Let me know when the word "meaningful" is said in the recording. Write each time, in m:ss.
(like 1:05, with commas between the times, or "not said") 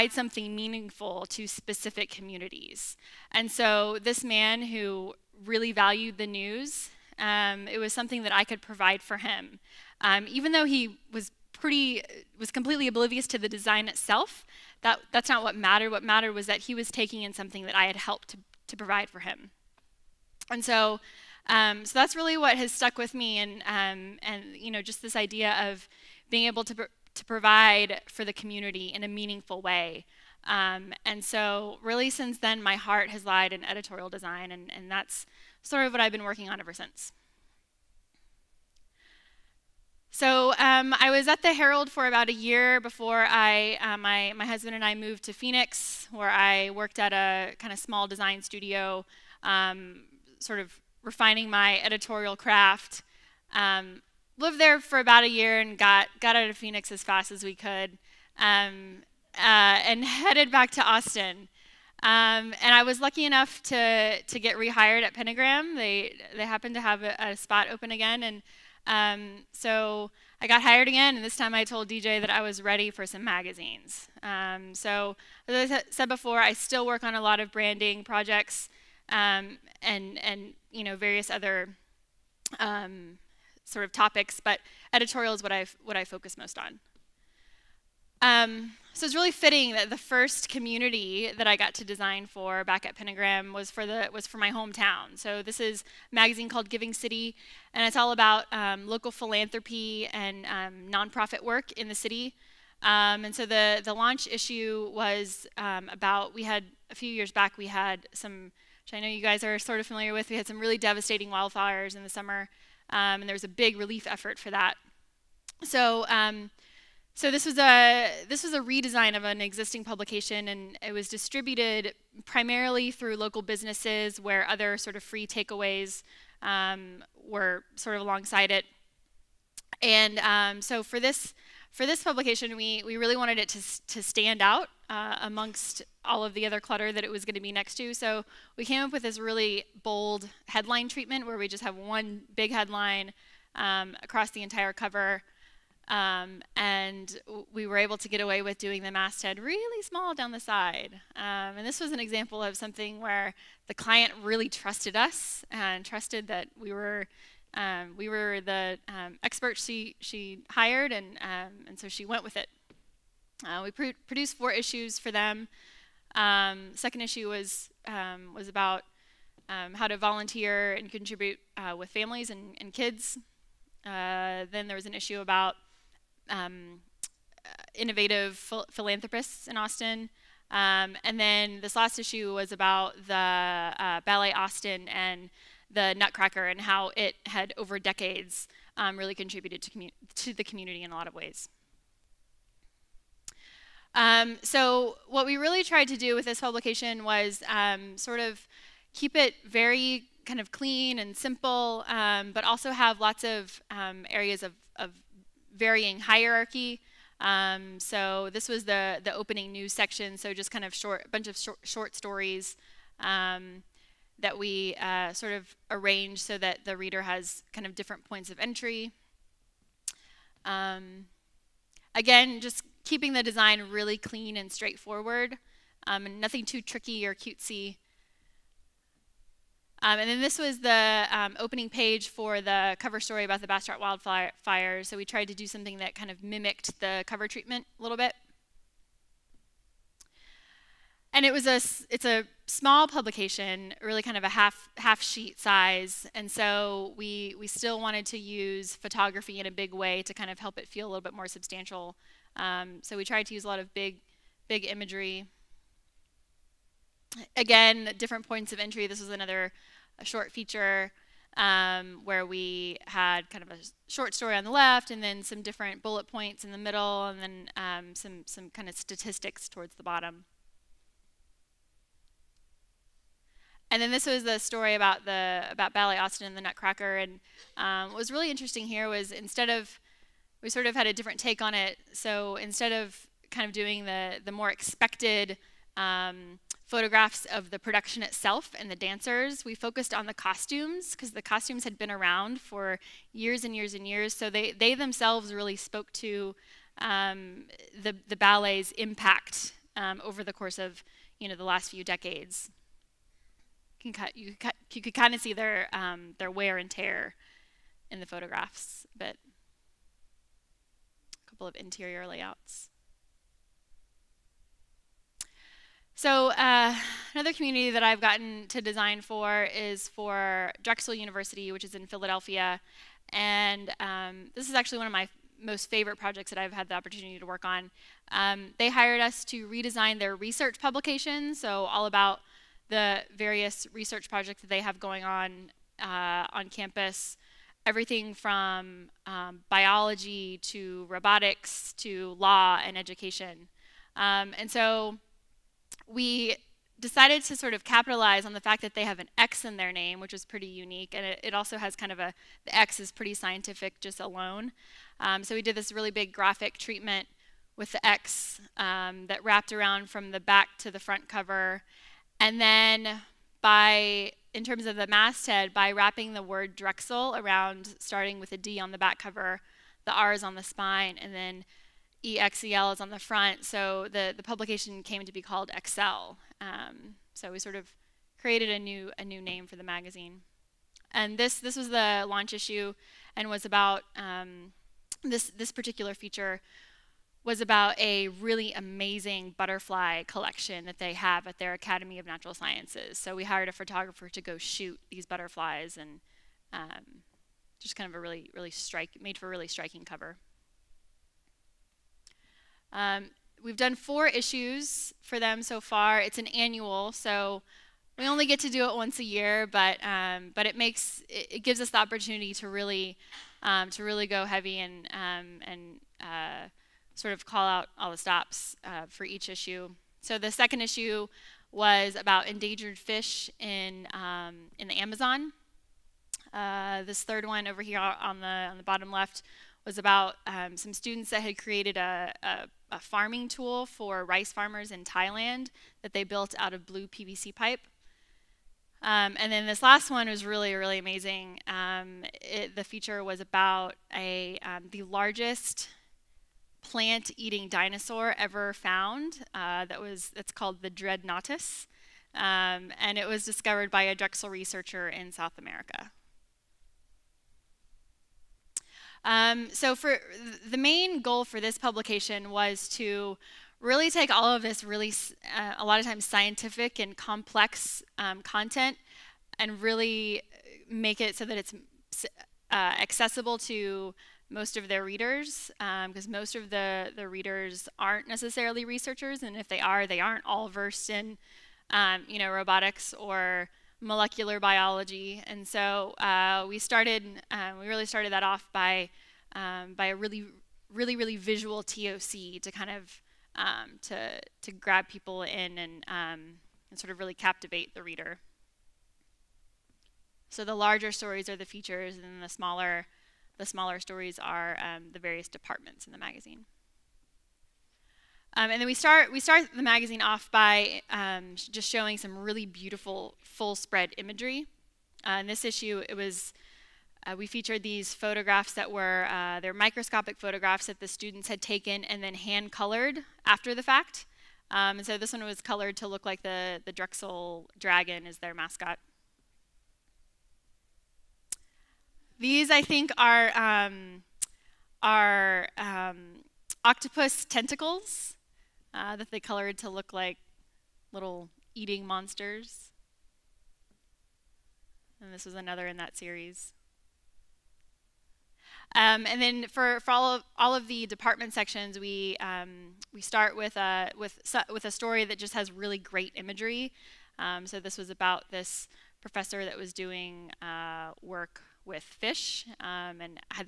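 0:00, 0:29.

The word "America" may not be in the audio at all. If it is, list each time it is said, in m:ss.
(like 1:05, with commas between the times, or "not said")
7:35.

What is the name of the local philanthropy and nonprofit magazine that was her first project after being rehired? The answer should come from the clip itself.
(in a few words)
Giving City.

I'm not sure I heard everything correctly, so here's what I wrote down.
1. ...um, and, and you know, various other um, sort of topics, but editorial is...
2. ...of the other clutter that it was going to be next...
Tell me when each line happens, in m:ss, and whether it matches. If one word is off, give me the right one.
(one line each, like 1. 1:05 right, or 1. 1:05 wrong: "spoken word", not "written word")
1. 1:19 right
2. 2:16 right.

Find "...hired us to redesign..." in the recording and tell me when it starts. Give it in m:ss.
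5:28.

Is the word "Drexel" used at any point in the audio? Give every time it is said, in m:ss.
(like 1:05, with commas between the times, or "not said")
5:20, 6:06, 7:33, 8:46.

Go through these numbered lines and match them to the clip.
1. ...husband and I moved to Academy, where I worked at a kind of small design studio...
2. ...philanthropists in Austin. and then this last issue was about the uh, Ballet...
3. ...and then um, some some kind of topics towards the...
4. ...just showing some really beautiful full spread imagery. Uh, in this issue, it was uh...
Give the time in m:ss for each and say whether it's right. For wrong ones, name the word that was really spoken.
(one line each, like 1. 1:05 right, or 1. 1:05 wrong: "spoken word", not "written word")
1. 0:44 wrong: "Phoenix", not "Academy"
2. 2:58 right
3. 4:27 wrong: "statistics", not "topics"
4. 8:31 right.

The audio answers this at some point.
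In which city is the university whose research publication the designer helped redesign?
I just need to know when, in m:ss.
5:21.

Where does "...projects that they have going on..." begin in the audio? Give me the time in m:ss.
5:34.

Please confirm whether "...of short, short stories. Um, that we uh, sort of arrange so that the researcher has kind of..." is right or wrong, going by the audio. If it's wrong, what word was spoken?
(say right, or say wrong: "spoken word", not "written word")
wrong: "reader", not "researcher".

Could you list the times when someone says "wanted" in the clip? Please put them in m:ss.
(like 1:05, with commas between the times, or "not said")
2:13, 4:07.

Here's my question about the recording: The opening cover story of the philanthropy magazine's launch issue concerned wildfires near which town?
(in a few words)
Bastrop.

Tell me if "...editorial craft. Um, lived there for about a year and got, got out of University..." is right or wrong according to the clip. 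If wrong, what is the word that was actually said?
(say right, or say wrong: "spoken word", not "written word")
wrong: "Phoenix", not "University".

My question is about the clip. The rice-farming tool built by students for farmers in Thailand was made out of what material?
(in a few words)
blue PVC pipe.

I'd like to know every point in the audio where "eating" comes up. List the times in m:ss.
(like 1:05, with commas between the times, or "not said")
7:26, 9:01.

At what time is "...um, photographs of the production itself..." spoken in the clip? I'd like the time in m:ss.
4:45.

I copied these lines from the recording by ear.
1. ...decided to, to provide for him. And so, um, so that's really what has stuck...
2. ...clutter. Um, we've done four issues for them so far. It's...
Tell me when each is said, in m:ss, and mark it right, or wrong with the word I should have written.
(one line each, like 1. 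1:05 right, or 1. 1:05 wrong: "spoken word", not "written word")
1. 0:17 wrong: "helped", not "decided"
2. 6:39 wrong: "cover", not "clutter".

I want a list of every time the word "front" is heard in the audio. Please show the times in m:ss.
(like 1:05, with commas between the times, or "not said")
6:00, 6:12.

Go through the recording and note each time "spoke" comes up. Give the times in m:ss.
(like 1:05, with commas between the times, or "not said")
4:55.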